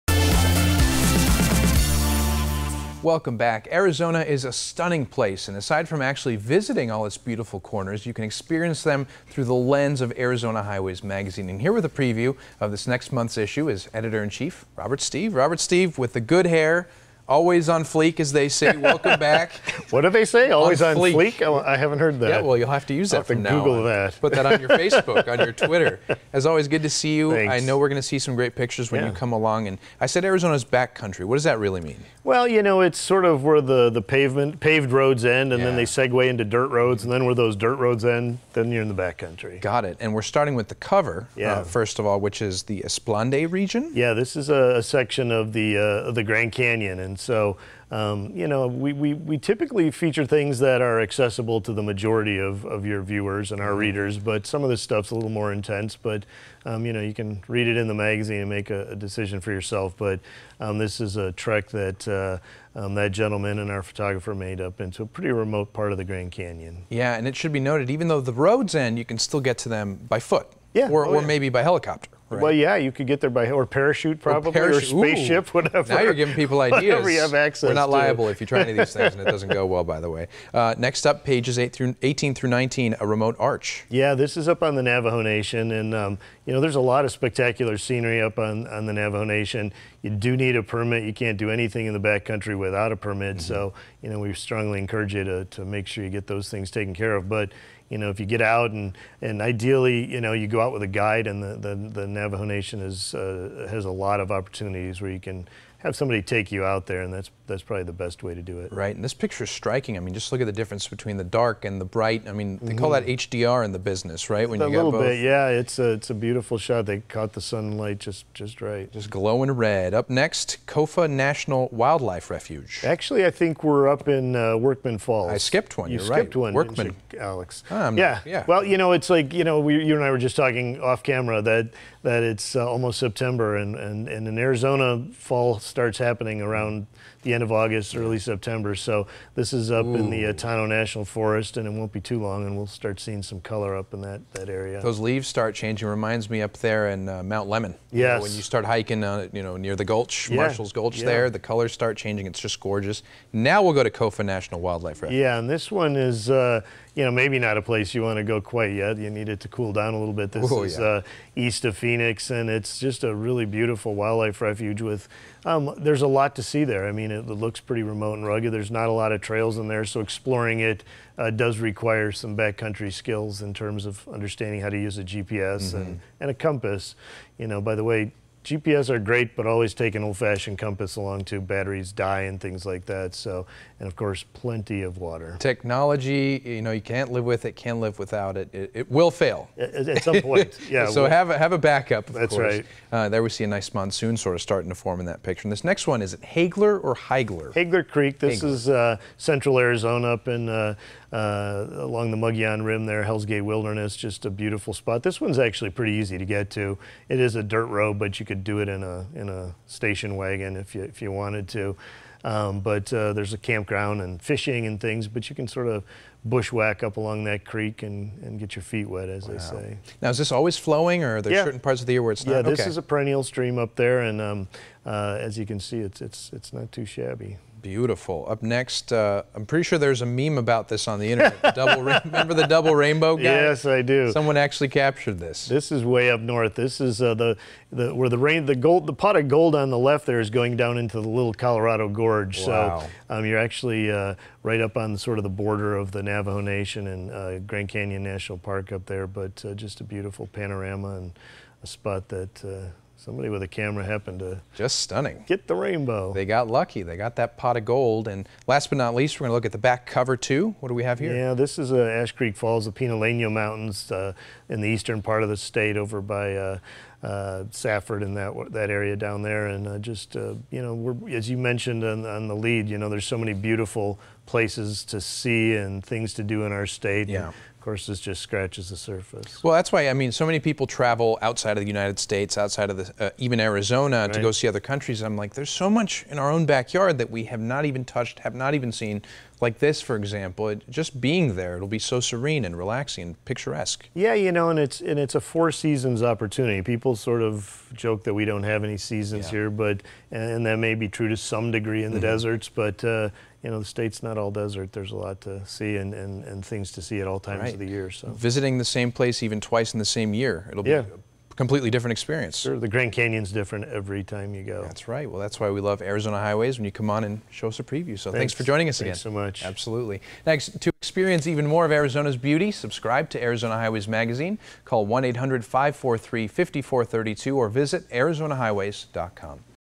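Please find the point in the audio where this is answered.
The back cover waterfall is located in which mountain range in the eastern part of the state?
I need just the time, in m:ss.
4:22.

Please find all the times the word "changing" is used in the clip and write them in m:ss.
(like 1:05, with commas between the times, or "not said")
2:25, 2:31.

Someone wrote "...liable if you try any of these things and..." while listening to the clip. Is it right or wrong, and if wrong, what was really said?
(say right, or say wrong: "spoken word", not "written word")
right.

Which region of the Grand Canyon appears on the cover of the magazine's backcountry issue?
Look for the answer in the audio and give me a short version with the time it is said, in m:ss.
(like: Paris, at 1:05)
Esplanade, at 0:42.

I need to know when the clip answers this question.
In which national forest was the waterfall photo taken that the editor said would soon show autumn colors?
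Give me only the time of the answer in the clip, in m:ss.
2:20.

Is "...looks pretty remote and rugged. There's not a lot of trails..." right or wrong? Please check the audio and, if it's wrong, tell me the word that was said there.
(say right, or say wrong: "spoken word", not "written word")
right.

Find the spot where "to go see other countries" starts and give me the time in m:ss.
4:44.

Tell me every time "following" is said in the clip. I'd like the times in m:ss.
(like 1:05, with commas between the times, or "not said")
not said.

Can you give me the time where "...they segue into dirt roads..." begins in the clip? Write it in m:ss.
0:35.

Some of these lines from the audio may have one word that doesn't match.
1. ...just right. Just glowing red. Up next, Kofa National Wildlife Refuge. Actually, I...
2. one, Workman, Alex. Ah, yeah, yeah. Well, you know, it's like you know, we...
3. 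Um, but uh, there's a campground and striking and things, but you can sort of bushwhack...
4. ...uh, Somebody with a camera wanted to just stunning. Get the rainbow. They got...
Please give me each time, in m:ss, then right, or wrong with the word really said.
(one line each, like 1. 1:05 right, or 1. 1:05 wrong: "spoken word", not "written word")
1. 1:58 right
2. 2:06 right
3. 3:32 wrong: "fishing", not "striking"
4. 4:12 wrong: "happened", not "wanted".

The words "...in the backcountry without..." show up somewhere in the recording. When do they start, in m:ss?
1:31.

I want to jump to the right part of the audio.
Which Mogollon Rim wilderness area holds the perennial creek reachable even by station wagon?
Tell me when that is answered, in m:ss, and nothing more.
3:23.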